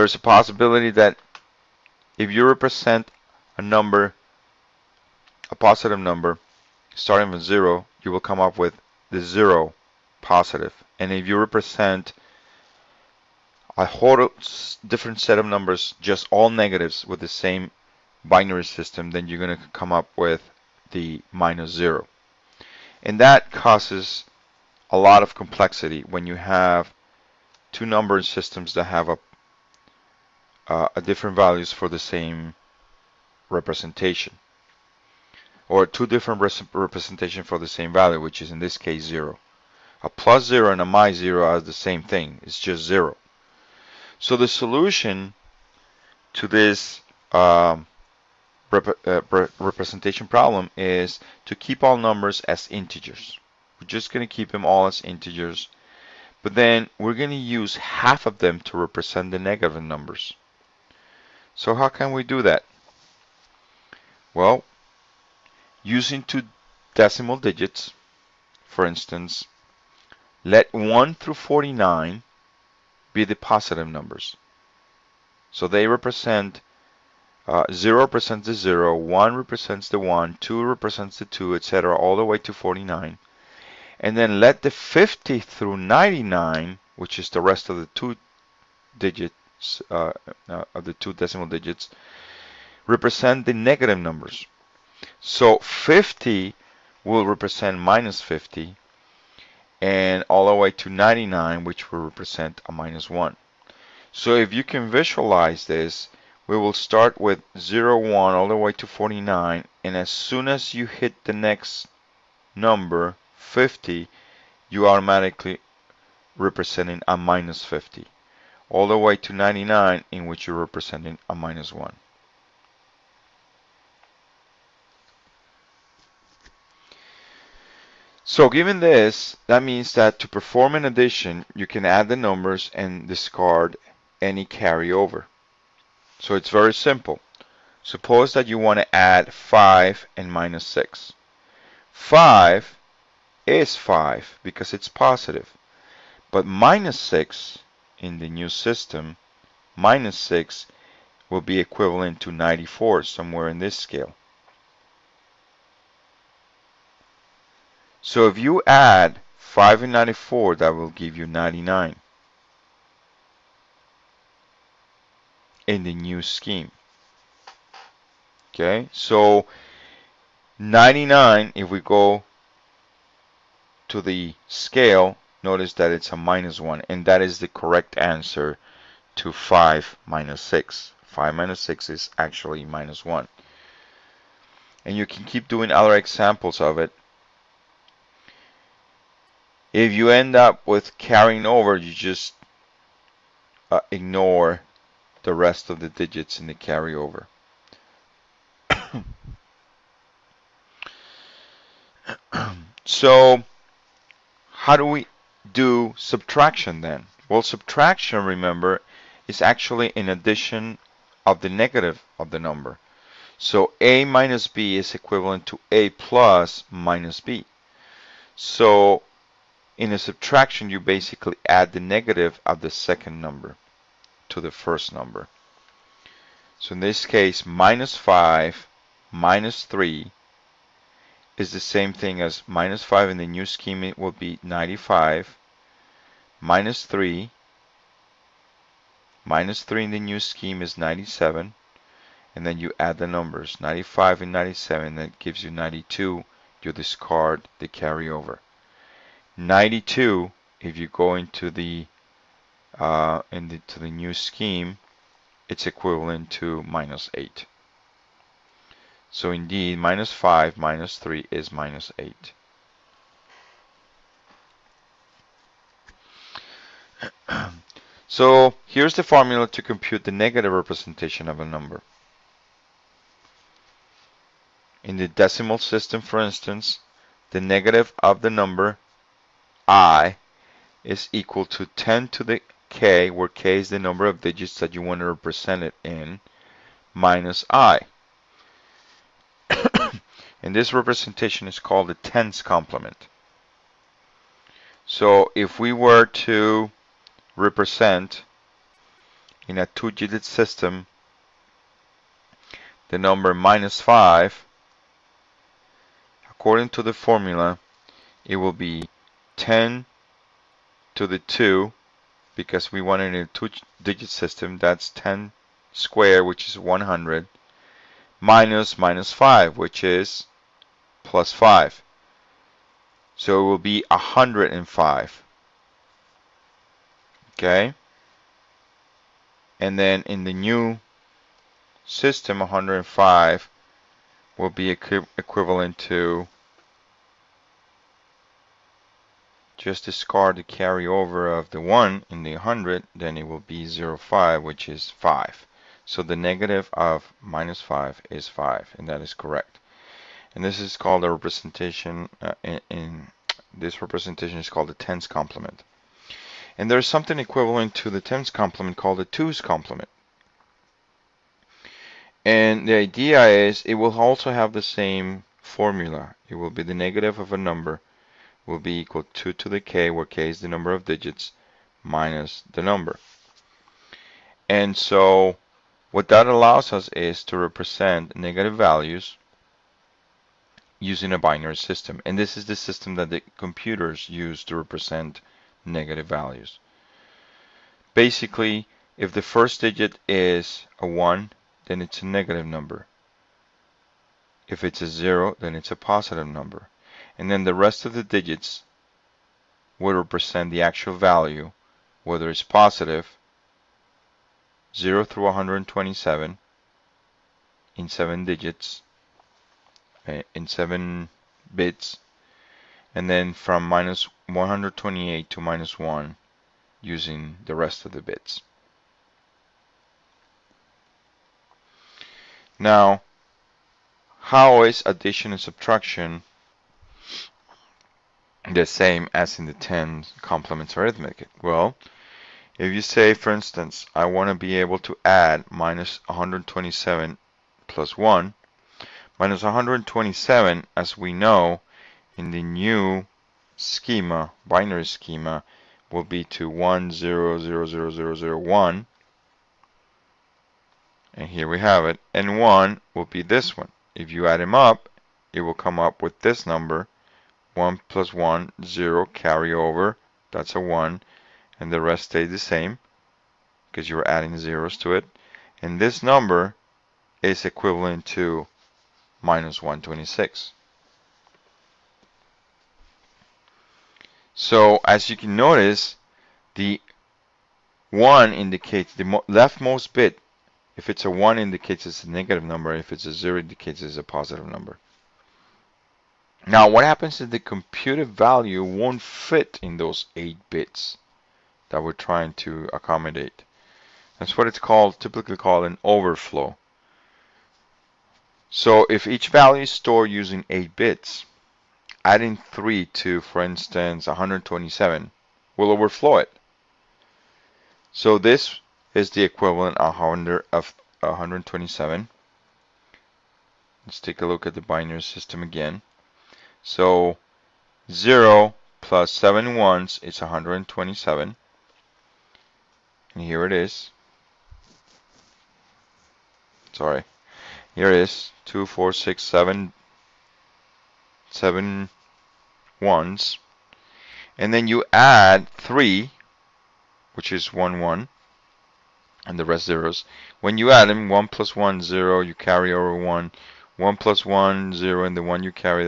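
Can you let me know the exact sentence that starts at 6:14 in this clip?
And so what that allows us is to represent negative values using a binary system.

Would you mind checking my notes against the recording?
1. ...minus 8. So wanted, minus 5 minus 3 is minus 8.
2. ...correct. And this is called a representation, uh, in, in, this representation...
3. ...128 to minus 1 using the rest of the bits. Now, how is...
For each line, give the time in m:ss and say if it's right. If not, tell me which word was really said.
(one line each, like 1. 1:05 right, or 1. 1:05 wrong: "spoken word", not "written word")
1. 4:16 wrong: "indeed", not "wanted"
2. 5:49 right
3. 6:54 right.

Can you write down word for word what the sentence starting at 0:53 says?
We're just going to keep them all as integers.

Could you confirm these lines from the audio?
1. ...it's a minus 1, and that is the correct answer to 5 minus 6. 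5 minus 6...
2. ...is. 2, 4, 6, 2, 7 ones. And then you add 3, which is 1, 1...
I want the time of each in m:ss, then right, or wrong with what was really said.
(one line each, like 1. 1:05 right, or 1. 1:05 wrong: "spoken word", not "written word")
1. 2:55 right
2. 8:47 wrong: "7", not "2".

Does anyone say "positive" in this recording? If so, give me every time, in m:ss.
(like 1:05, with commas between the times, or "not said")
0:05, 0:10, 1:13, 2:24, 6:35, 6:42, 8:04.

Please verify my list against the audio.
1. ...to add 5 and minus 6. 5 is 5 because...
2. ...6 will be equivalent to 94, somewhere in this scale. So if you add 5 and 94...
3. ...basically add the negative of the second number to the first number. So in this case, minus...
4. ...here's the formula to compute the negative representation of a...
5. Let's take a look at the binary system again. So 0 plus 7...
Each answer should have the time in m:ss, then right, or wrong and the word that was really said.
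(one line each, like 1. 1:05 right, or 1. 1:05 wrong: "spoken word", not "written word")
1. 2:18 right
2. 2:30 right
3. 3:40 right
4. 4:28 right
5. 8:33 right.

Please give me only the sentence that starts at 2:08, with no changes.
So given this, that means that to perform an addition, you can add the numbers and discard any carryover.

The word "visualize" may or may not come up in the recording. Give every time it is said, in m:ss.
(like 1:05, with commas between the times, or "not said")
1:44.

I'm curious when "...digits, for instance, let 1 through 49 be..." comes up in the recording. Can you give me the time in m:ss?
1:07.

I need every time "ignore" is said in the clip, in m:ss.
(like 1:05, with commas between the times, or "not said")
3:13.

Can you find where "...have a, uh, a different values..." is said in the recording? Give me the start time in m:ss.
0:28.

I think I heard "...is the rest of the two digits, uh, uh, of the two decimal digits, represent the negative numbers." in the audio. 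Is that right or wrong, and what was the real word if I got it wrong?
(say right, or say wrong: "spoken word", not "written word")
right.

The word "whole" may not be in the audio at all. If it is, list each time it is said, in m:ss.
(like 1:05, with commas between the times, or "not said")
0:13.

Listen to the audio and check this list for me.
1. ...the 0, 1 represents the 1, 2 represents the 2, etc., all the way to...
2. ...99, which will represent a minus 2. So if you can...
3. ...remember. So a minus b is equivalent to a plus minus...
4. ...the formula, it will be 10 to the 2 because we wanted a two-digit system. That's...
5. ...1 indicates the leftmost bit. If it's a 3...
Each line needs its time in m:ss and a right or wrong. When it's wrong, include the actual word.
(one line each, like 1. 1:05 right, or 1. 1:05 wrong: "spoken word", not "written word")
1. 1:18 right
2. 1:40 wrong: "1", not "2"
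3. 3:32 wrong: "number", not "remember"
4. 5:06 right
5. 7:57 wrong: "1", not "3".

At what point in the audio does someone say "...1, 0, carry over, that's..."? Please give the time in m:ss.
7:38.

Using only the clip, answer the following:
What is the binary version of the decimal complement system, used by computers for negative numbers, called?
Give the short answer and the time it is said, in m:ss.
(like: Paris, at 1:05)
twos complement, at 5:59.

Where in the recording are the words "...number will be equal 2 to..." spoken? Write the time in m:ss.
6:07.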